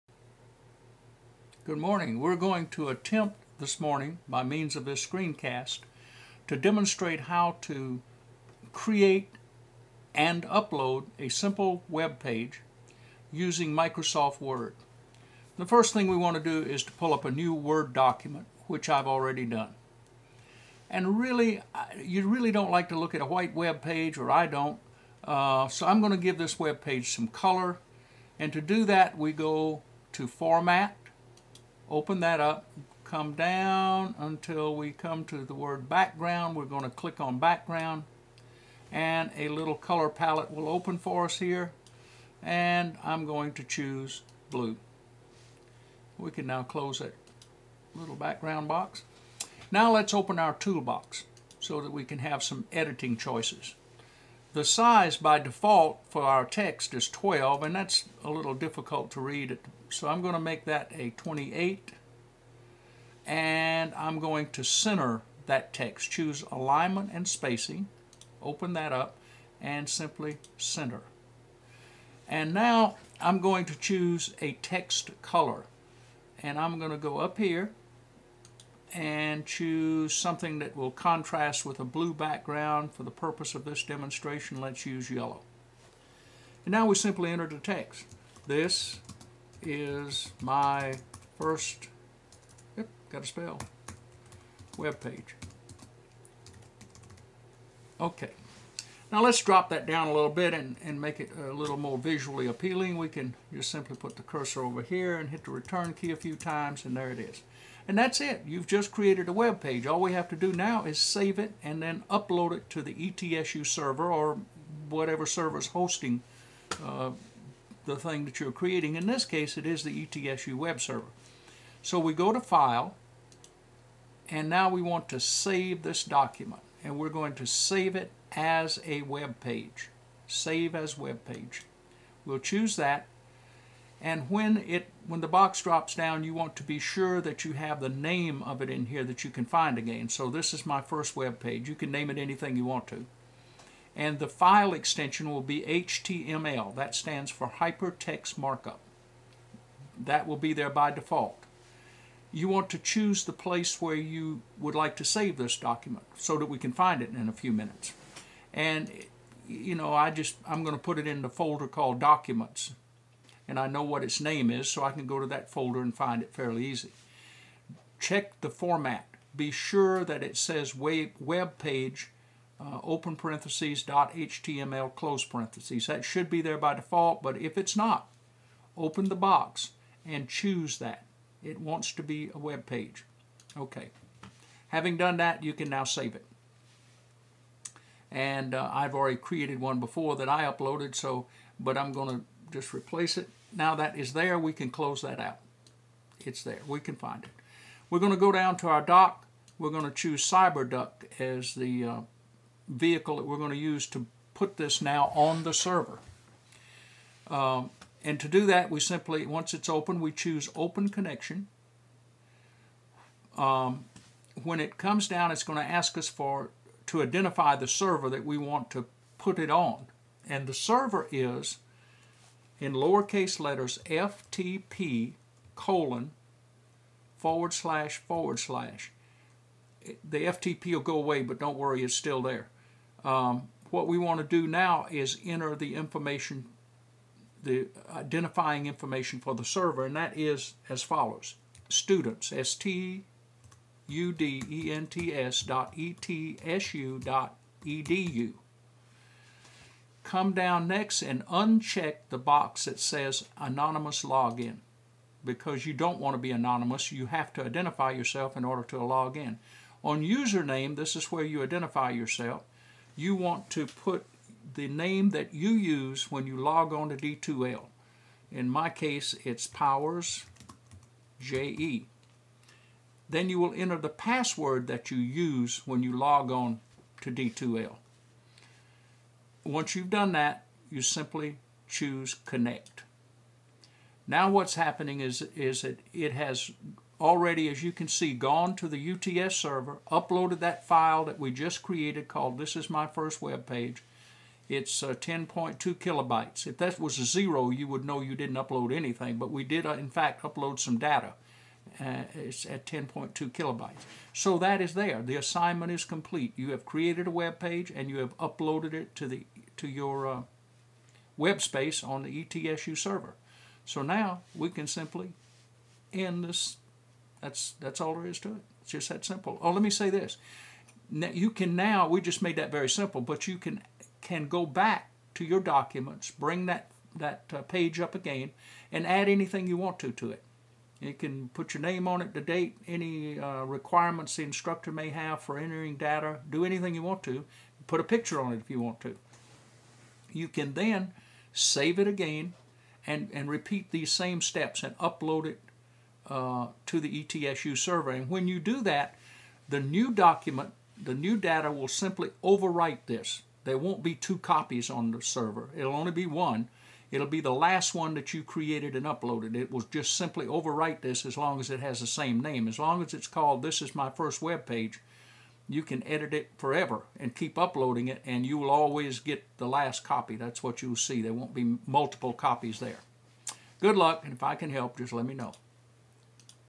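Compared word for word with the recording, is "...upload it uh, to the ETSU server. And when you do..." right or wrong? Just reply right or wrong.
right.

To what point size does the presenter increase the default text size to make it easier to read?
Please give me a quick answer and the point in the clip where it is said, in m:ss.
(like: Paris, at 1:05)
28, at 1:01.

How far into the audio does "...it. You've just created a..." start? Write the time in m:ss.
1:48.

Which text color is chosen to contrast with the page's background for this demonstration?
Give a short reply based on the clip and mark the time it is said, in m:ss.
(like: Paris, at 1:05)
yellow, at 1:25.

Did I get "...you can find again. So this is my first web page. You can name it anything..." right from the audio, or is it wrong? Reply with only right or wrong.
right.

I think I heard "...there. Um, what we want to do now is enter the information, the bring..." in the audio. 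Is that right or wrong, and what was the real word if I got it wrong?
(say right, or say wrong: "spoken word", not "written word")
wrong: "identifying", not "bring".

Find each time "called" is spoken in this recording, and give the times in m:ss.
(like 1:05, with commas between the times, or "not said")
2:41, 4:52, 6:03.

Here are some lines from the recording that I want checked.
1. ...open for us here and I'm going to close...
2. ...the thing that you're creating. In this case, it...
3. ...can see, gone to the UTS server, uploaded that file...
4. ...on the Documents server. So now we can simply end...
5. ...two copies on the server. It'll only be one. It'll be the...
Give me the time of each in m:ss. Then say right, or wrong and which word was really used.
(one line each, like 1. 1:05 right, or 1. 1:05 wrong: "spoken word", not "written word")
1. 0:40 wrong: "choose", not "close"
2. 1:57 right
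3. 4:47 right
4. 5:11 wrong: "ETSU", not "Documents"
5. 5:53 right.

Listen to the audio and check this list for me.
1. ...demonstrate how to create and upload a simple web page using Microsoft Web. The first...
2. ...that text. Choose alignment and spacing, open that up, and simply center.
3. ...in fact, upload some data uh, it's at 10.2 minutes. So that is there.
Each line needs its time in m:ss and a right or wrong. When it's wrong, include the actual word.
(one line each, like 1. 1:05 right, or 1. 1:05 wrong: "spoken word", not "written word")
1. 0:06 wrong: "Word", not "Web"
2. 1:05 right
3. 4:59 wrong: "kilobytes", not "minutes".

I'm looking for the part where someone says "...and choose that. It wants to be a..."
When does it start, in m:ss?
3:00.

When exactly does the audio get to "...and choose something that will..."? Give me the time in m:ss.
1:18.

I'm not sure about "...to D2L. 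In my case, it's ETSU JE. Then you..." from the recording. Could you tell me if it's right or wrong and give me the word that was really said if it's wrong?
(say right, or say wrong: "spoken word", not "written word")
wrong: "Powers", not "ETSU".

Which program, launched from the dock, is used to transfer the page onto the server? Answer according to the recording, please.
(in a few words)
CyberDuck.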